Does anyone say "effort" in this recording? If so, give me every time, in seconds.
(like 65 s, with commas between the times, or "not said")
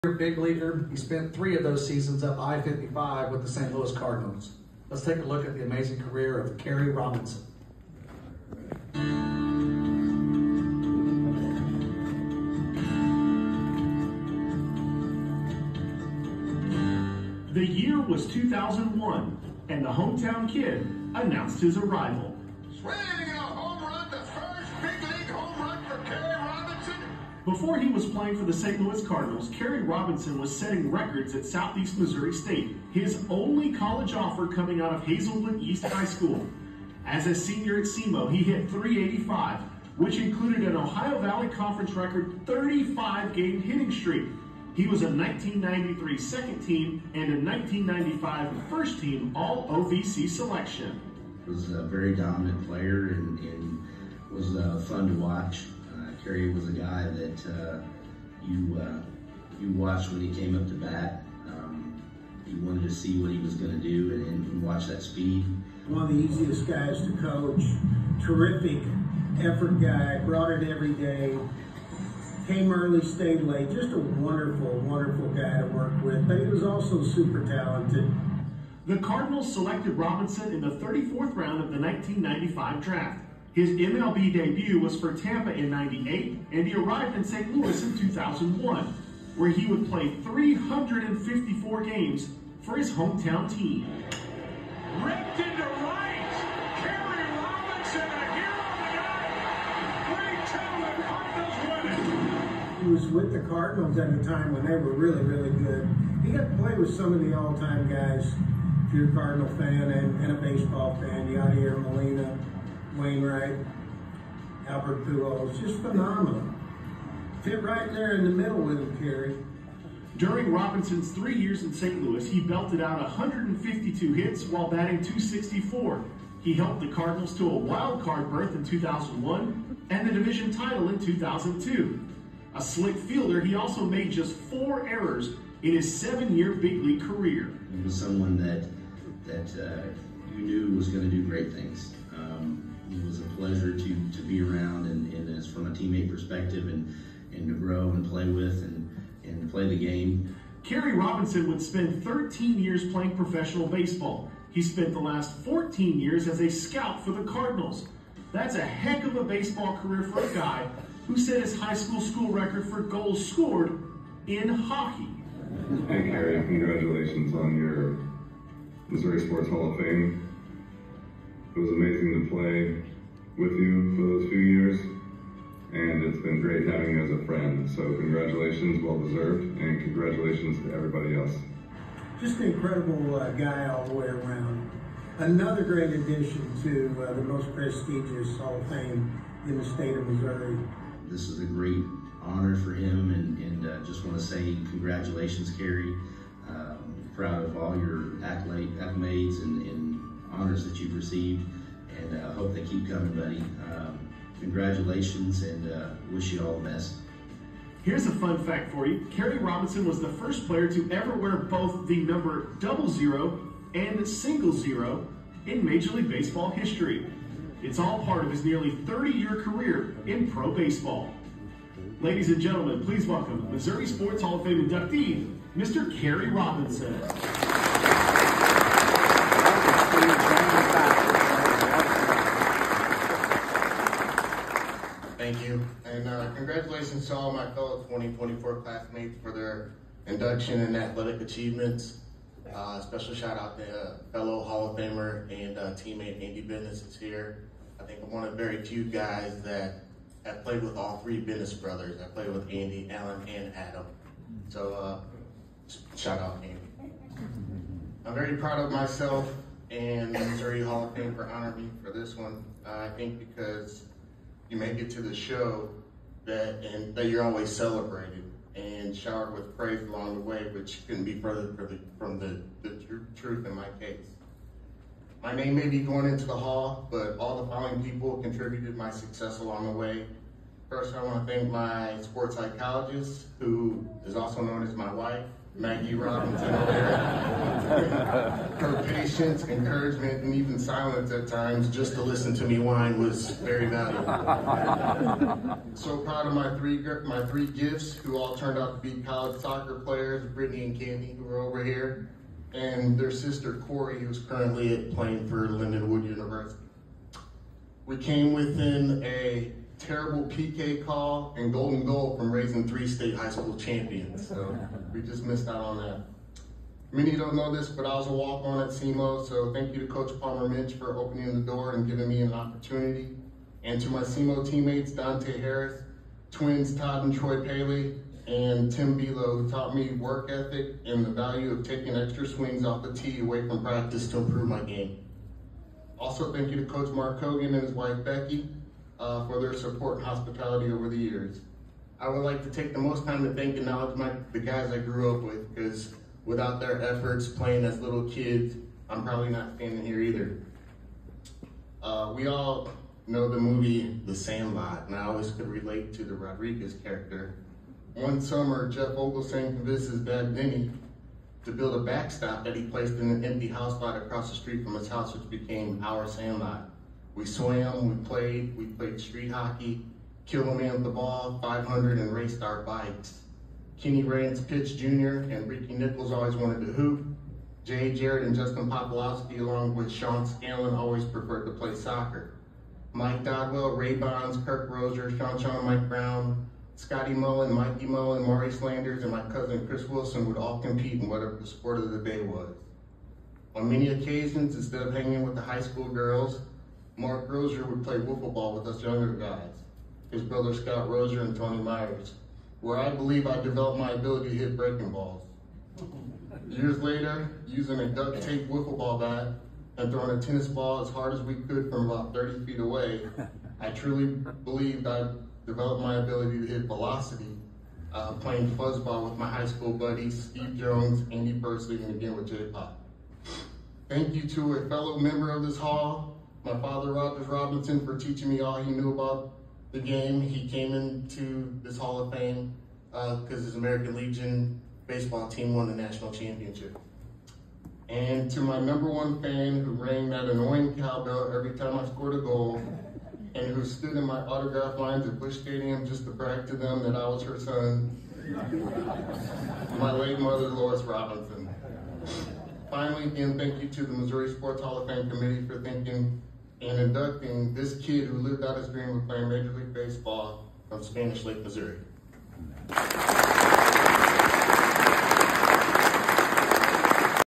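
69 s, 346 s.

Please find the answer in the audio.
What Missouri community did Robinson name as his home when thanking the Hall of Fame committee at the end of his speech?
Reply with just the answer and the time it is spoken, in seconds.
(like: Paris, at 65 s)
Spanish Lake, at 460 s.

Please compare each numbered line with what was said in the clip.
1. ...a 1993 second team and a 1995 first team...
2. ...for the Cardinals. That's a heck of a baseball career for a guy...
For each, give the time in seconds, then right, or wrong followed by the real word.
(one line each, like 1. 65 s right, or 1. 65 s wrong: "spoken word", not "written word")
1. 45 s right
2. 157 s right.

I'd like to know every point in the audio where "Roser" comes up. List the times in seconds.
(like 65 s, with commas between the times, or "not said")
384 s, 400 s.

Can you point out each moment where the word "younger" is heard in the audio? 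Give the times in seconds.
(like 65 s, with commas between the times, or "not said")
398 s.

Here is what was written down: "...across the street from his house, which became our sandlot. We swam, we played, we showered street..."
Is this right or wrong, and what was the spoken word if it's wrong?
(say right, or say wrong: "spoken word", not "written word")
wrong: "played", not "showered".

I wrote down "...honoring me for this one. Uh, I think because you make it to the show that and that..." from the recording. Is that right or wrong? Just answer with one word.
right.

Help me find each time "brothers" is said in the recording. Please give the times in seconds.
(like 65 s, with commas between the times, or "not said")
251 s, 400 s.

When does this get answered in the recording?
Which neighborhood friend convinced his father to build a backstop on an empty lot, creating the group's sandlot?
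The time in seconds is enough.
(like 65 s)
358 s.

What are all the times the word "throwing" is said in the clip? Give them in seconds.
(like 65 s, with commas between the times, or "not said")
409 s.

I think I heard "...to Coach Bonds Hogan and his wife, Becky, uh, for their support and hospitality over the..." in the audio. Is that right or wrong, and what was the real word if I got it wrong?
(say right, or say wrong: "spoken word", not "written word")
wrong: "Mark", not "Bonds".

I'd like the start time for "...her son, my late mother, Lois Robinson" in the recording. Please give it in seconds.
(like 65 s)
447 s.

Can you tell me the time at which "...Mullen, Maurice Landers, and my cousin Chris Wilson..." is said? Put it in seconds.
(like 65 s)
387 s.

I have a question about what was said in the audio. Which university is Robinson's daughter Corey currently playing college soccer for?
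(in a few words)
Lindenwood University.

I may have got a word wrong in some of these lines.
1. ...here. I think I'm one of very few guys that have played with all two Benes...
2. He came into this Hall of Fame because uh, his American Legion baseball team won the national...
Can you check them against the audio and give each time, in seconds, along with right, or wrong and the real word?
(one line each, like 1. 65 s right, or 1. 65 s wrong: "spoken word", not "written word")
1. 246 s wrong: "three", not "two"
2. 430 s right.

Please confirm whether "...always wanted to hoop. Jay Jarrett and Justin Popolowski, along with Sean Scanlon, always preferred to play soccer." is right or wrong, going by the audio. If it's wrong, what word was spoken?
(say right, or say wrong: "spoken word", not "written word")
right.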